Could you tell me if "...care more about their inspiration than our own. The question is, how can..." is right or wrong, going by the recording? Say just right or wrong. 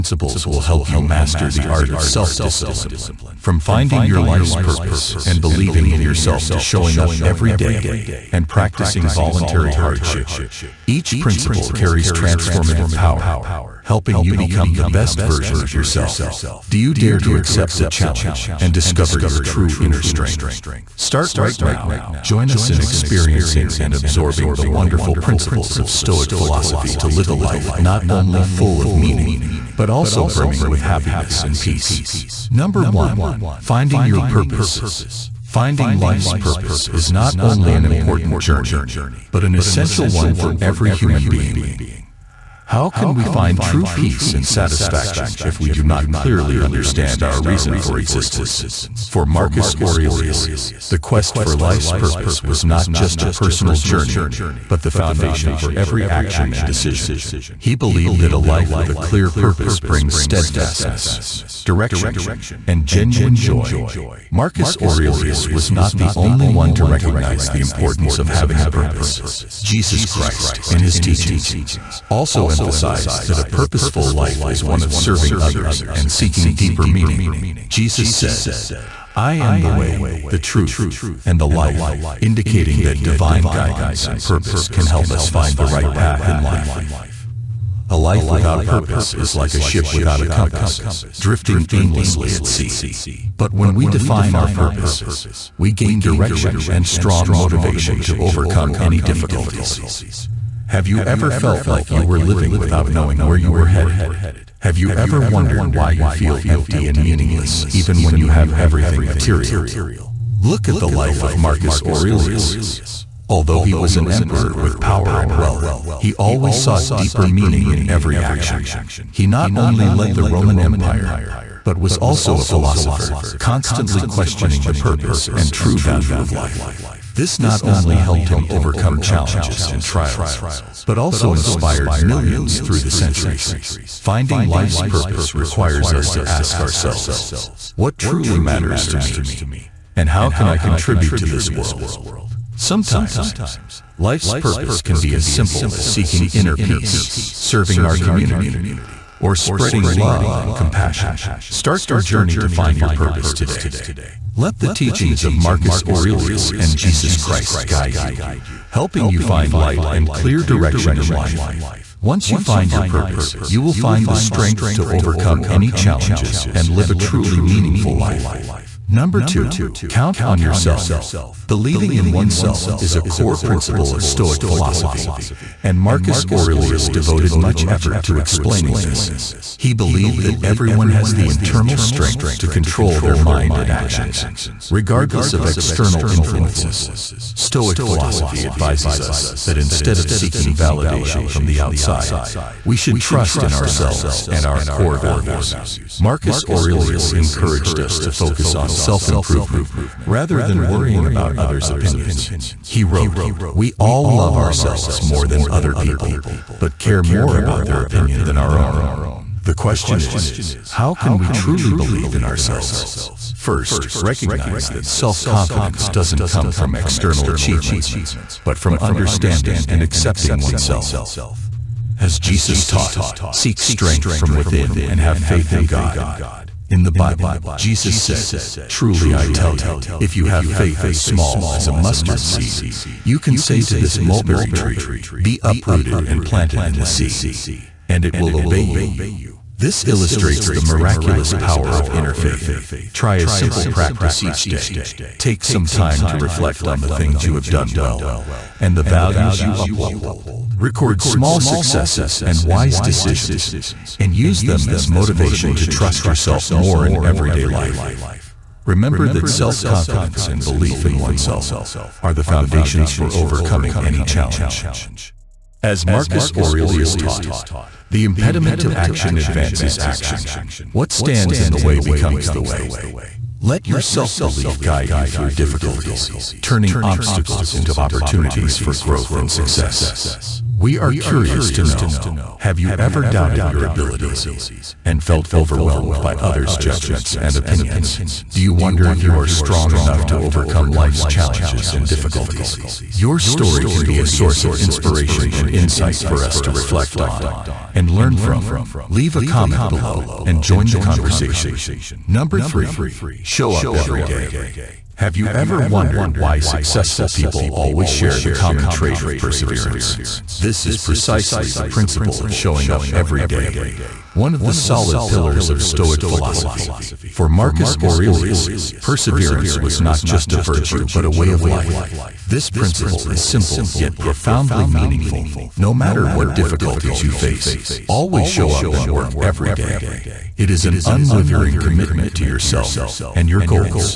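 wrong.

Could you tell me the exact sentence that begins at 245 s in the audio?
Take some time to reflect on the things you have done well and the values you uphold.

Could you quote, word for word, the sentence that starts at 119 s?
He not only led the Roman Empire, but was also a philosopher, constantly questioning the purpose and true value of life.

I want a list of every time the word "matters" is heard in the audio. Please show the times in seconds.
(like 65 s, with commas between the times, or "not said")
138 s, 325 s.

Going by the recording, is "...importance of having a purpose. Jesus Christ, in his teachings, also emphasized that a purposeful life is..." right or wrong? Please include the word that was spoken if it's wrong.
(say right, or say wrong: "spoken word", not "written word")
right.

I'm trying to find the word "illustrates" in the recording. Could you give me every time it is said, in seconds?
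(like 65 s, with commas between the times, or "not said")
239 s.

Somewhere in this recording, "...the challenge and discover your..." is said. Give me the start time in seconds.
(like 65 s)
17 s.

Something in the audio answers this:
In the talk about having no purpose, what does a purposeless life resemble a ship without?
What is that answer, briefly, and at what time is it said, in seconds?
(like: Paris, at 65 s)
A compass, at 90 s.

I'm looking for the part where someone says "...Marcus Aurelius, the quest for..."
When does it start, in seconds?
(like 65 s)
49 s.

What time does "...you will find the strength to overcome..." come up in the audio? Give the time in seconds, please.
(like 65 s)
163 s.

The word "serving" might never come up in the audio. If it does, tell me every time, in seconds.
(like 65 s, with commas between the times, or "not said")
74 s, 147 s.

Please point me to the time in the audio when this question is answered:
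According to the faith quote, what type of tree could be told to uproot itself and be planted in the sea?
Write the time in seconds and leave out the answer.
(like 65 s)
233 s.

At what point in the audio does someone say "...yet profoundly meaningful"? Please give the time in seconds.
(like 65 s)
323 s.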